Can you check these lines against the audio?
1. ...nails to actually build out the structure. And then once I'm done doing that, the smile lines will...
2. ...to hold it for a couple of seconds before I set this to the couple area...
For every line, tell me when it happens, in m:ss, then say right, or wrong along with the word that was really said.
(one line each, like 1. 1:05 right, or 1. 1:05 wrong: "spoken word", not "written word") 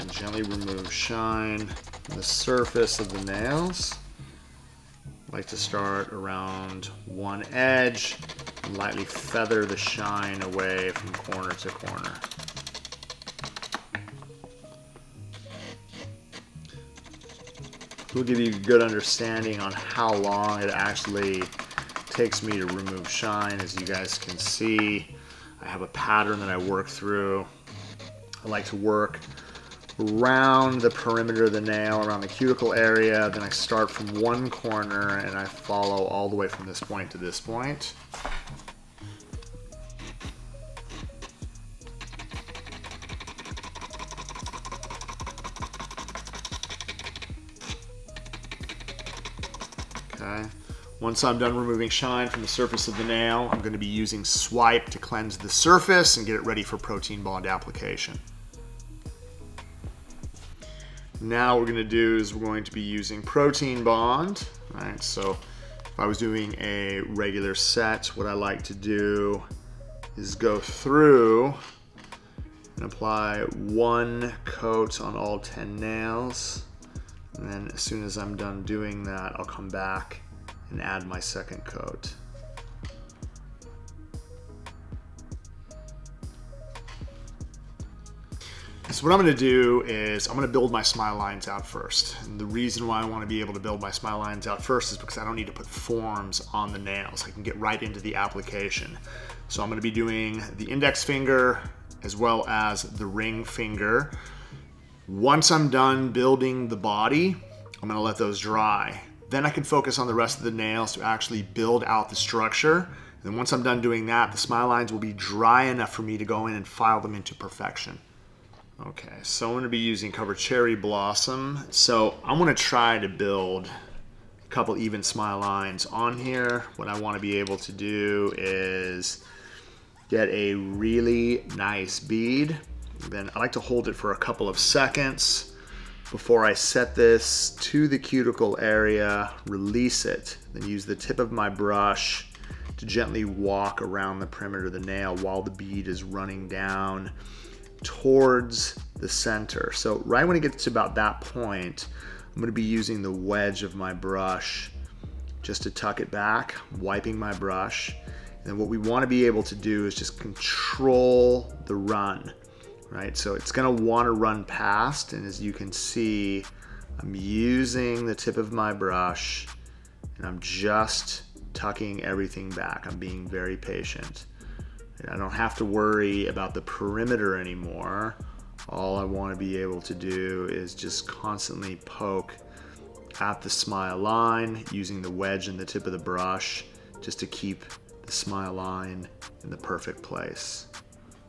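1. 1:50 right
2. 2:13 wrong: "cuticle", not "couple".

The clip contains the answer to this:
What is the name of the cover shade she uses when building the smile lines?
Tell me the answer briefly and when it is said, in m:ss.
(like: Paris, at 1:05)
Cover Cherry Blossom, at 2:00.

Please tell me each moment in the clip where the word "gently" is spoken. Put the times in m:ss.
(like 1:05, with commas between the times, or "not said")
0:00, 2:22.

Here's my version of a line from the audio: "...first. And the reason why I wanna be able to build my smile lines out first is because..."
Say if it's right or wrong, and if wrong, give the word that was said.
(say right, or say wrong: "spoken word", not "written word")
right.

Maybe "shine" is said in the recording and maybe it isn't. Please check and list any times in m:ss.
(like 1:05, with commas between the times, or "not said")
0:00, 0:09, 0:23, 0:51.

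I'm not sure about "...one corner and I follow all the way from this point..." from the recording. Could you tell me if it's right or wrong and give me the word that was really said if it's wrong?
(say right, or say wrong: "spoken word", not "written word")
right.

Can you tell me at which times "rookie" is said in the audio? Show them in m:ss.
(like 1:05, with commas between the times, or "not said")
not said.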